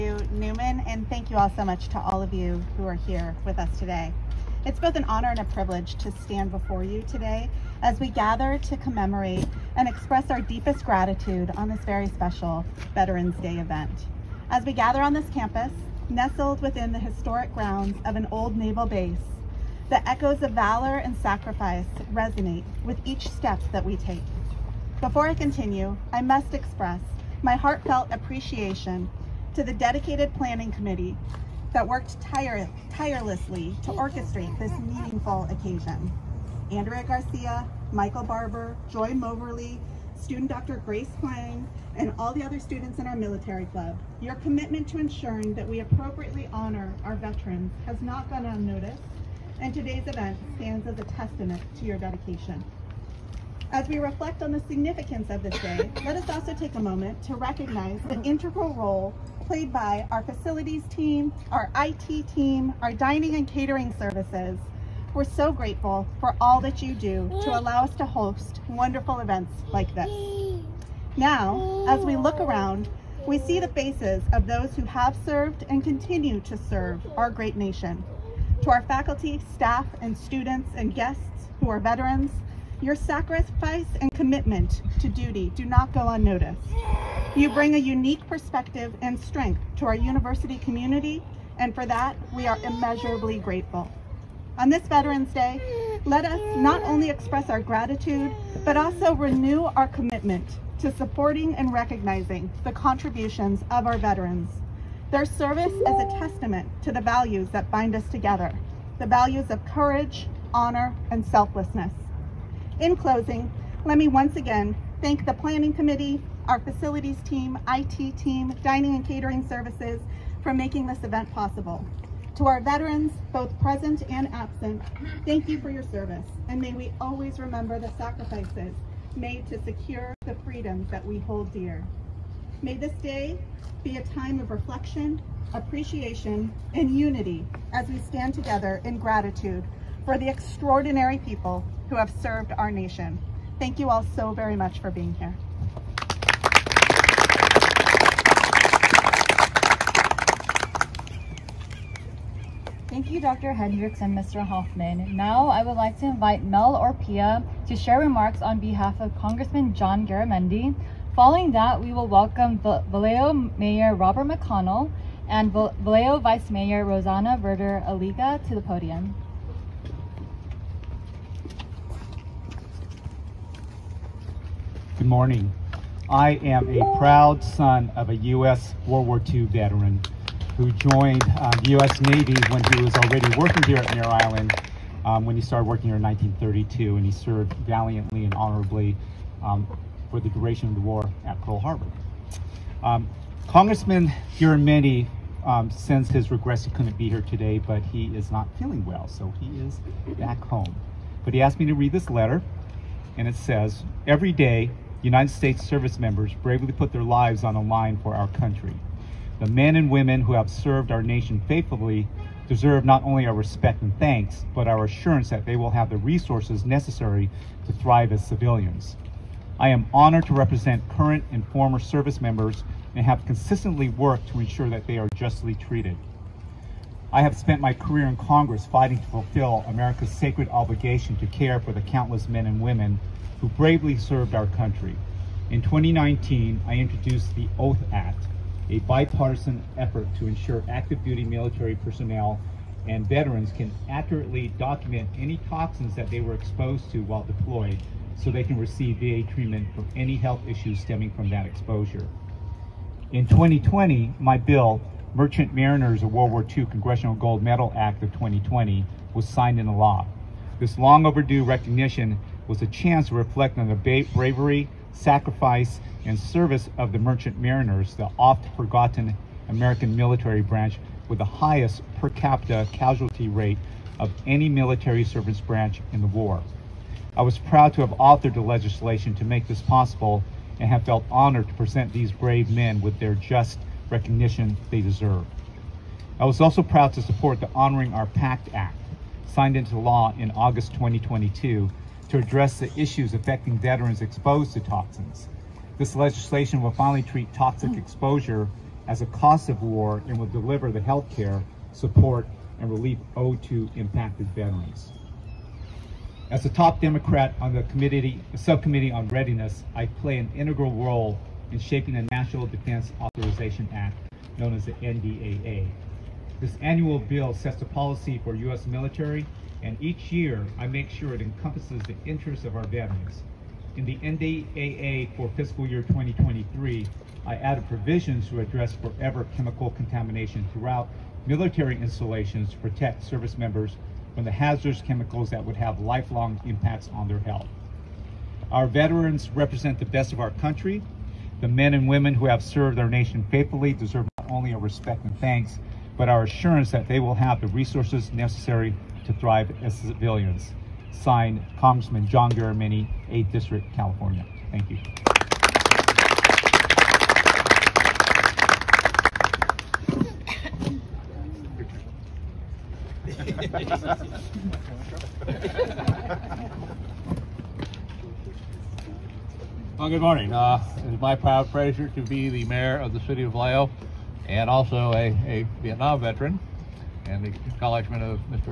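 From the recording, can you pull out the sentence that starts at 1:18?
To our faculty, staff, and students and guests who are veterans, your sacrifice and commitment to duty do not go unnoticed.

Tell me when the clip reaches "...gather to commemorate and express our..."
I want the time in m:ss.
0:08.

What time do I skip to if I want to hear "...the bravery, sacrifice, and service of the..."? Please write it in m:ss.
4:23.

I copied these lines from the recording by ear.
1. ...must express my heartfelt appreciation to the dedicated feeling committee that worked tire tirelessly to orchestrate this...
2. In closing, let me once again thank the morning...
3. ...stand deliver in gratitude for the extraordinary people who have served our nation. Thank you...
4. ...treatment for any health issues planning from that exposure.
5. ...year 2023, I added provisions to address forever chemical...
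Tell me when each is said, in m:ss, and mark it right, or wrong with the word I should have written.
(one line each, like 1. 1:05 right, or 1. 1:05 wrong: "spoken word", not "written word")
1. 0:26 wrong: "planning", not "feeling"
2. 1:52 wrong: "planning", not "morning"
3. 2:17 wrong: "together", not "deliver"
4. 4:09 wrong: "stemming", not "planning"
5. 5:25 right.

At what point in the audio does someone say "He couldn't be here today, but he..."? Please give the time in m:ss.
3:16.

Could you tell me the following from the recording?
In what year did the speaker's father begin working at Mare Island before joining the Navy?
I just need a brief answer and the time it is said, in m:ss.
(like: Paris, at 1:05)
1932, at 3:06.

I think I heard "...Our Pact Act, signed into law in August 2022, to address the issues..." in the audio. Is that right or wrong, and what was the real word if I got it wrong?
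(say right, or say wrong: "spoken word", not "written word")
right.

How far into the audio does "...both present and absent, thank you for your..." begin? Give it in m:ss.
2:03.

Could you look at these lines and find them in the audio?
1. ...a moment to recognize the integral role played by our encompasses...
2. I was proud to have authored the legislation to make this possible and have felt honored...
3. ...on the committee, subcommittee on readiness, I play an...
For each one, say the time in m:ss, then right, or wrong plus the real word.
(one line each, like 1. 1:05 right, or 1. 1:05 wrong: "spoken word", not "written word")
1. 0:56 wrong: "facilities", not "encompasses"
2. 4:37 right
3. 5:07 right.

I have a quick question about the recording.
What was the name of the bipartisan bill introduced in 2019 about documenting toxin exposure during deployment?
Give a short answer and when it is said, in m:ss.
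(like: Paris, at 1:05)
Oath Act, at 3:57.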